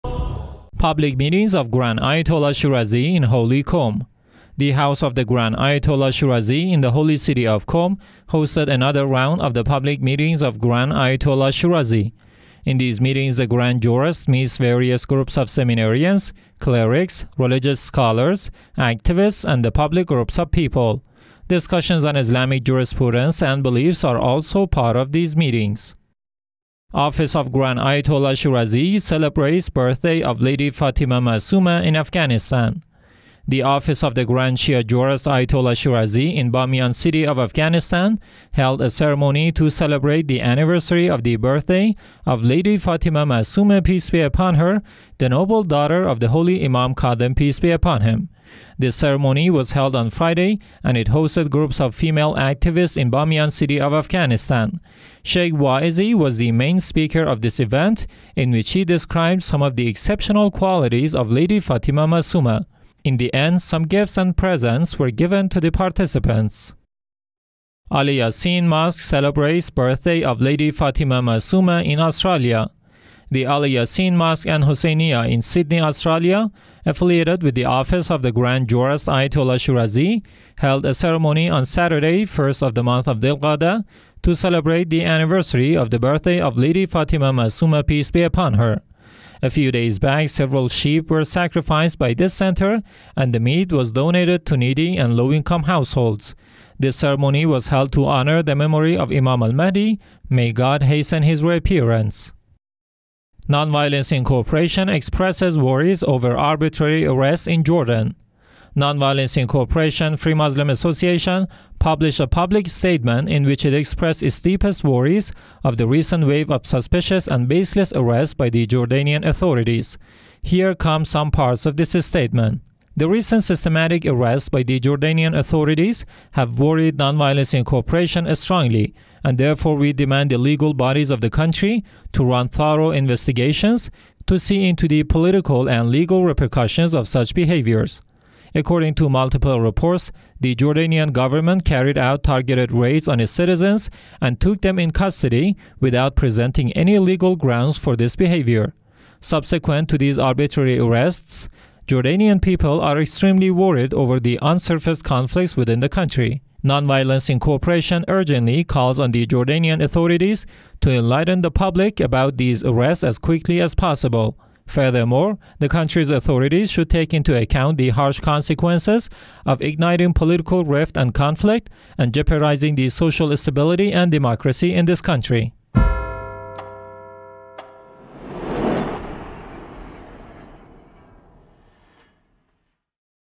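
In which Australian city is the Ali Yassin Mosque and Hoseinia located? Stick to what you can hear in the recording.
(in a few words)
Sydney.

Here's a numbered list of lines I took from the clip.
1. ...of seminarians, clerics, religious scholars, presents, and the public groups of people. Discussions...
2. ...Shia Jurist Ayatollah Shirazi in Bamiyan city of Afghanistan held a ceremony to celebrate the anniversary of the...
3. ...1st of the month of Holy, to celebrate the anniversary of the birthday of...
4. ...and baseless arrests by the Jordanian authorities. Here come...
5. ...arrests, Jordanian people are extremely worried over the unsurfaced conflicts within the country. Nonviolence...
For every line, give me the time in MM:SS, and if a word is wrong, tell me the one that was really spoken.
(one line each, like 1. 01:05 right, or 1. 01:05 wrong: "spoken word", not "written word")
1. 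00:15 wrong: "activists", not "presents"
2. 00:34 right
3. 01:22 wrong: "Dilqada", not "Holy"
4. 01:57 right
5. 02:30 right.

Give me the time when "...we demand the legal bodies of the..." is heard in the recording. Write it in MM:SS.
02:09.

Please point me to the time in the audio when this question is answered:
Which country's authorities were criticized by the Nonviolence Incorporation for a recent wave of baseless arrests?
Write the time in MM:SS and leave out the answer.
01:47.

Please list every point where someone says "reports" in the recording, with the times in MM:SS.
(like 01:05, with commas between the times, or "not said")
02:19.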